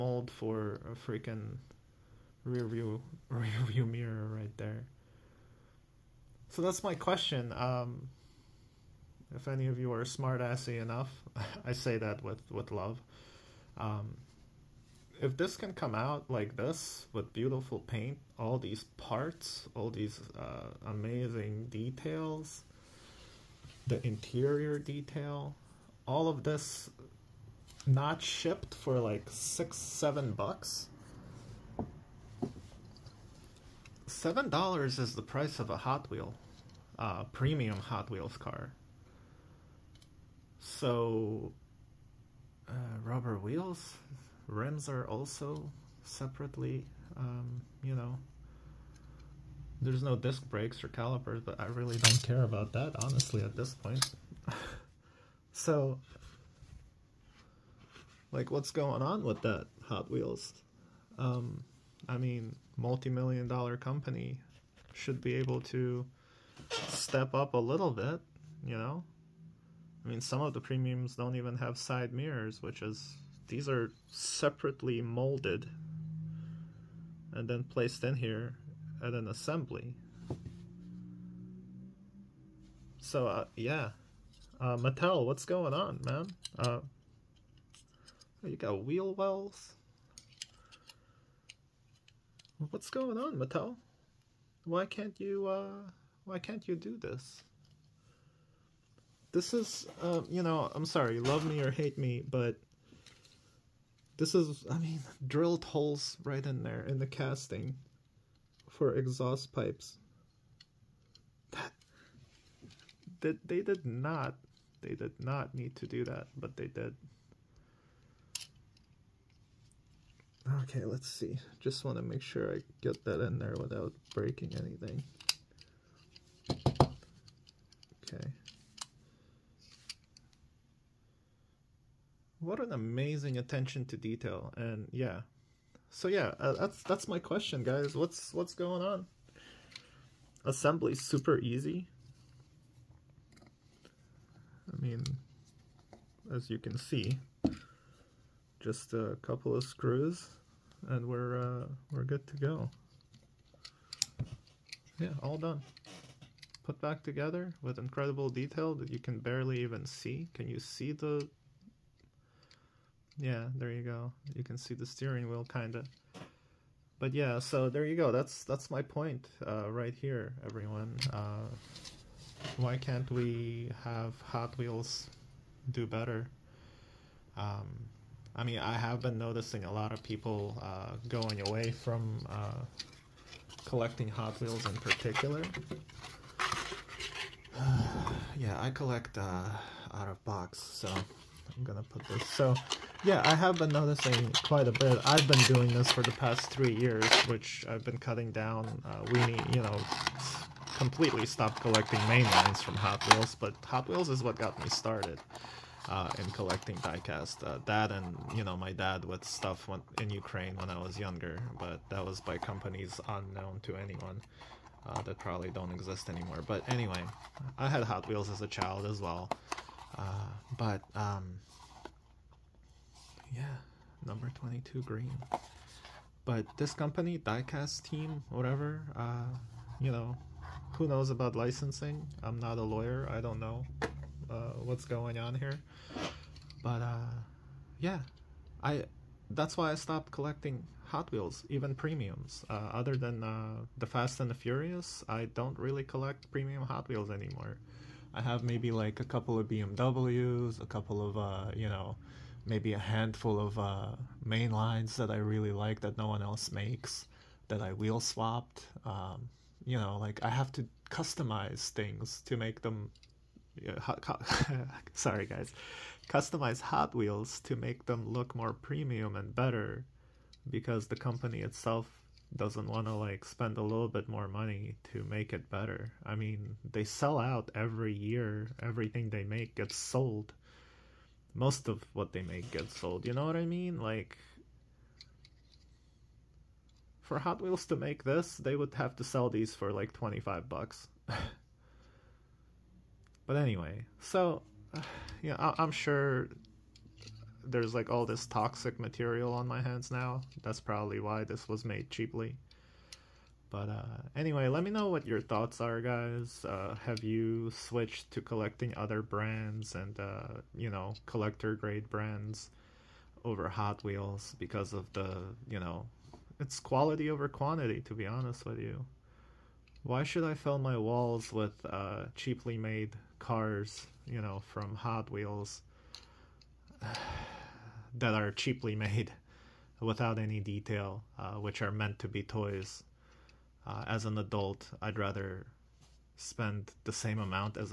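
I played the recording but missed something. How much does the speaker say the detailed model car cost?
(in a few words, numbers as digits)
$7.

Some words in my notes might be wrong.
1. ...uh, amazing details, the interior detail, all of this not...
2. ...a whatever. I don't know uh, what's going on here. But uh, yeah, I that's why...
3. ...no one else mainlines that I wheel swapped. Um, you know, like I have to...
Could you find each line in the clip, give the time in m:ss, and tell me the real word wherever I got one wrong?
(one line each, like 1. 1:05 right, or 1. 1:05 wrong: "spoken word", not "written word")
1. 0:20 right
2. 3:52 wrong: "lawyer", not "whatever"
3. 4:15 wrong: "makes", not "mainlines".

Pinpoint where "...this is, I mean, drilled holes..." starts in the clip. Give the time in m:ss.
1:44.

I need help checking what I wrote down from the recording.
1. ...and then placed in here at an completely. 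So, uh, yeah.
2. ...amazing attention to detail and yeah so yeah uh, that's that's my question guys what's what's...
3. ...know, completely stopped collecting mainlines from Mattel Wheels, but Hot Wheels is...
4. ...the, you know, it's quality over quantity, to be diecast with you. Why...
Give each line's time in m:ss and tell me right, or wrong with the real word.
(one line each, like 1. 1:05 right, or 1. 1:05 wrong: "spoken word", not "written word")
1. 1:17 wrong: "assembly", not "completely"
2. 2:12 right
3. 3:19 wrong: "Hot", not "Mattel"
4. 5:14 wrong: "honest", not "diecast".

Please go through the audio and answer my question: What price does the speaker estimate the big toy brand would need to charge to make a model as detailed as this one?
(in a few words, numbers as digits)
$25.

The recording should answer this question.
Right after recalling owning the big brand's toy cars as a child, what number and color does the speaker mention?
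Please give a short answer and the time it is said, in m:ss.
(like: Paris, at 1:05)
Number 22 green, at 3:44.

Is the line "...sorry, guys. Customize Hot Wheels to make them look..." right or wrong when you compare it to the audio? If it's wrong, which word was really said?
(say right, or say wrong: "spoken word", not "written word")
right.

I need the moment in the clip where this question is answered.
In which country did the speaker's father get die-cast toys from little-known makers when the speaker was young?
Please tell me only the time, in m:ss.
3:30.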